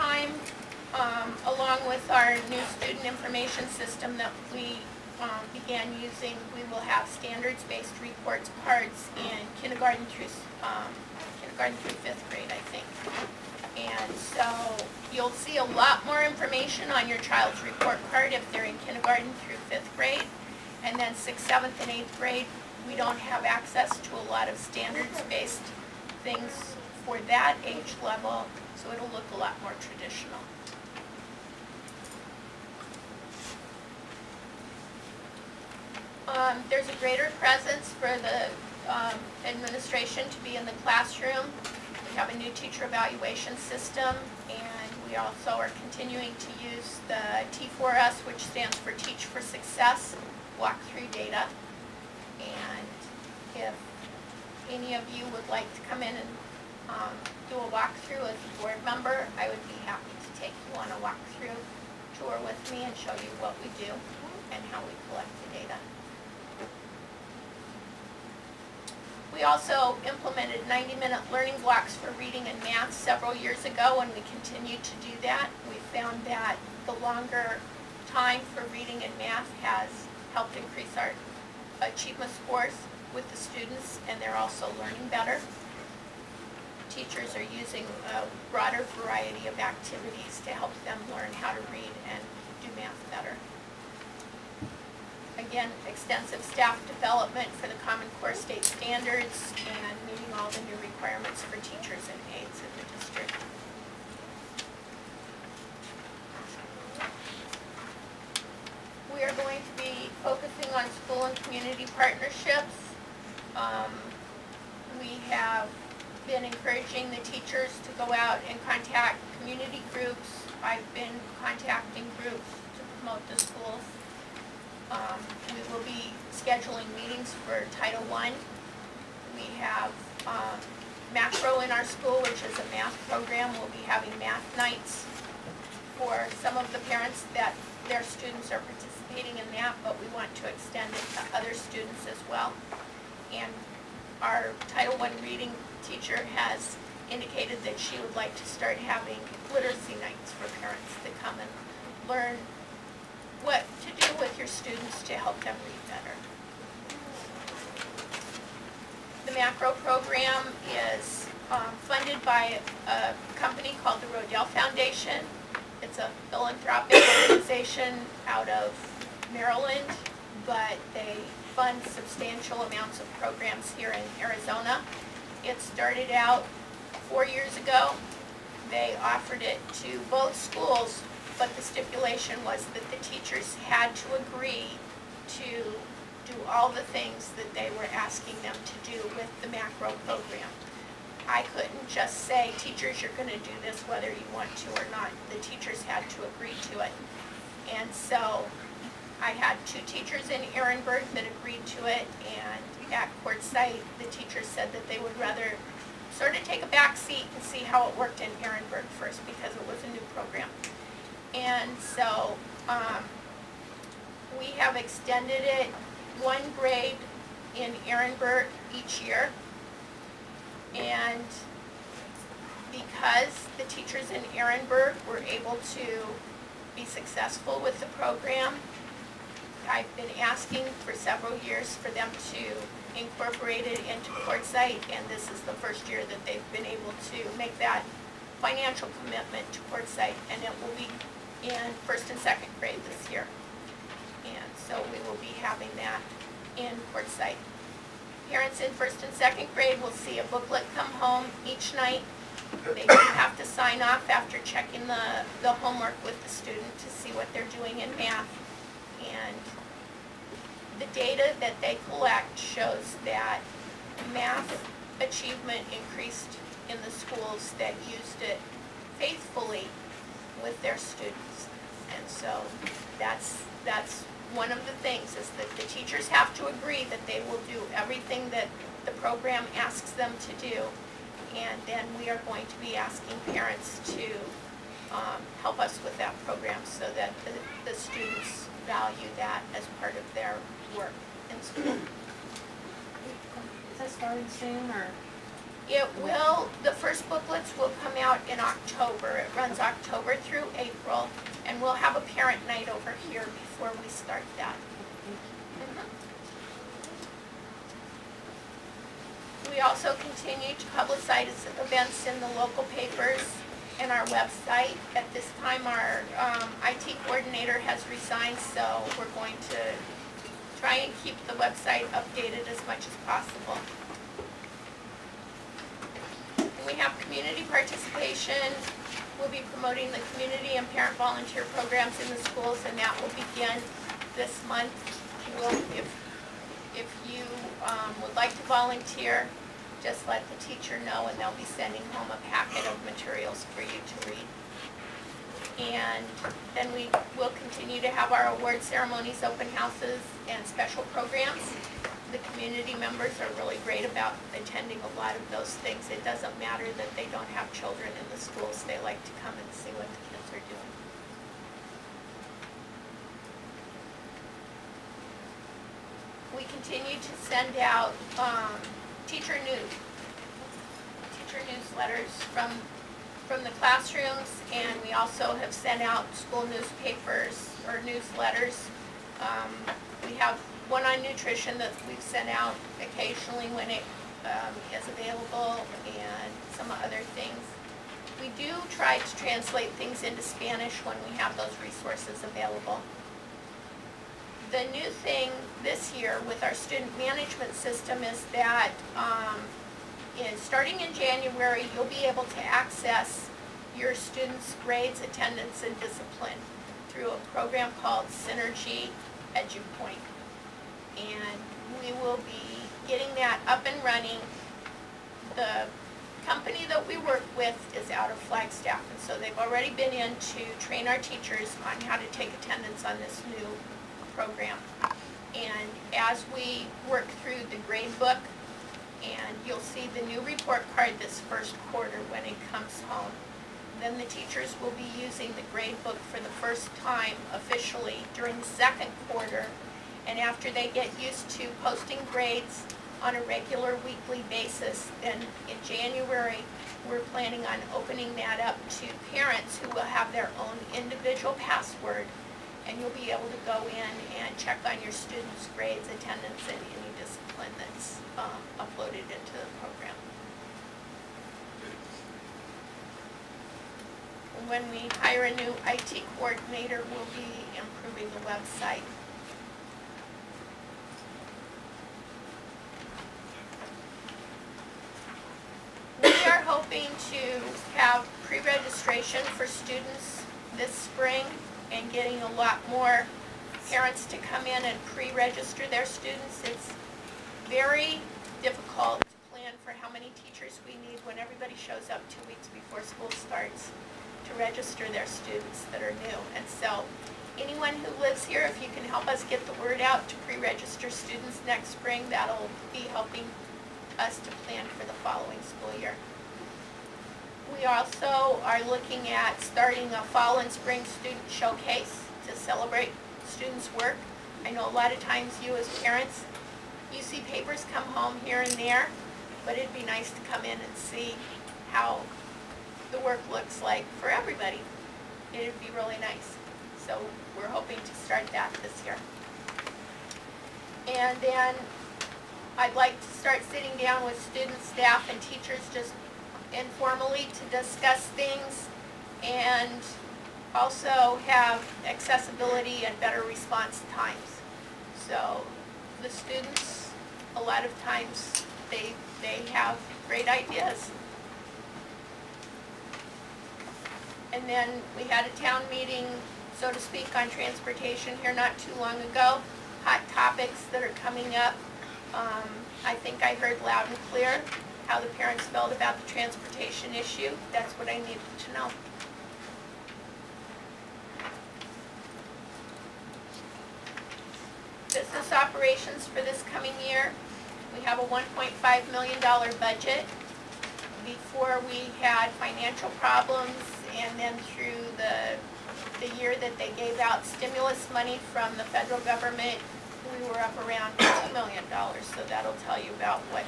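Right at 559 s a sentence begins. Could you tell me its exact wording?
Hot topics that are coming up.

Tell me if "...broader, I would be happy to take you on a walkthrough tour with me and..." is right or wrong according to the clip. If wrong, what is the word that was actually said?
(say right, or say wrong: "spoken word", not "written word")
wrong: "member", not "broader".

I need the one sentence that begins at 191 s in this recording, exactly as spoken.
I couldn't just say, teachers, you're going to do this whether you want to or not.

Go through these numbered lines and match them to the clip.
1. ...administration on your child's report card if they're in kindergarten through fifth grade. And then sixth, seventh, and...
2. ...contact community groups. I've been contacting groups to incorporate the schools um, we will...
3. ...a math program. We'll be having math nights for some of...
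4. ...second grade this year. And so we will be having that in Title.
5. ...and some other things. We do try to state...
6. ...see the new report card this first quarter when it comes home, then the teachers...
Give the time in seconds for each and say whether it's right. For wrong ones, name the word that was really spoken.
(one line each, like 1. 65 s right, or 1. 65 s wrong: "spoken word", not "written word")
1. 16 s wrong: "information", not "administration"
2. 118 s wrong: "promote", not "incorporate"
3. 132 s right
4. 242 s wrong: "Quartzsite", not "Title"
5. 385 s wrong: "translate", not "state"
6. 429 s right.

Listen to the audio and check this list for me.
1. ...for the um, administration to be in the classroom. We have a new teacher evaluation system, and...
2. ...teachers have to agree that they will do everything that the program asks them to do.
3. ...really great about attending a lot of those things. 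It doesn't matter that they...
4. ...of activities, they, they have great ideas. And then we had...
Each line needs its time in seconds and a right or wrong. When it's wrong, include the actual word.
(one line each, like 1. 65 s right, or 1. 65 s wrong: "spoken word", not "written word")
1. 37 s right
2. 275 s right
3. 353 s right
4. 547 s wrong: "times", not "activities".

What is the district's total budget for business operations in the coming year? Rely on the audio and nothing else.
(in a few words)
$1.5 million.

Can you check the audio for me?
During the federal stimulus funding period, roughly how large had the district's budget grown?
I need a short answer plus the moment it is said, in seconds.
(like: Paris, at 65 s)
$2 million, at 590 s.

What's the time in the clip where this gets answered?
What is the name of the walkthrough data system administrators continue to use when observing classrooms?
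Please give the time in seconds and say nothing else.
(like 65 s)
48 s.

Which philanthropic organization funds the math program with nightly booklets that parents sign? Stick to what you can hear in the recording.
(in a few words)
Rodel Foundation.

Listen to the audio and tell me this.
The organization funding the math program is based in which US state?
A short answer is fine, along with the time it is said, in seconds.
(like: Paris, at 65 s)
Maryland, at 169 s.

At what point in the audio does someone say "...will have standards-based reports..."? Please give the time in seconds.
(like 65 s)
6 s.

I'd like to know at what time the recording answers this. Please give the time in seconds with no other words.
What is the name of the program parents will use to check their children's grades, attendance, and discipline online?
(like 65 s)
408 s.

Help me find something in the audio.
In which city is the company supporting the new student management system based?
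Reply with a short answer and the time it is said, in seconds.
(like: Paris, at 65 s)
Flagstaff, at 418 s.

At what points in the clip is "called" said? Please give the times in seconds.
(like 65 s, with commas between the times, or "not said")
163 s, 407 s.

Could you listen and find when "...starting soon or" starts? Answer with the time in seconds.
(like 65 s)
293 s.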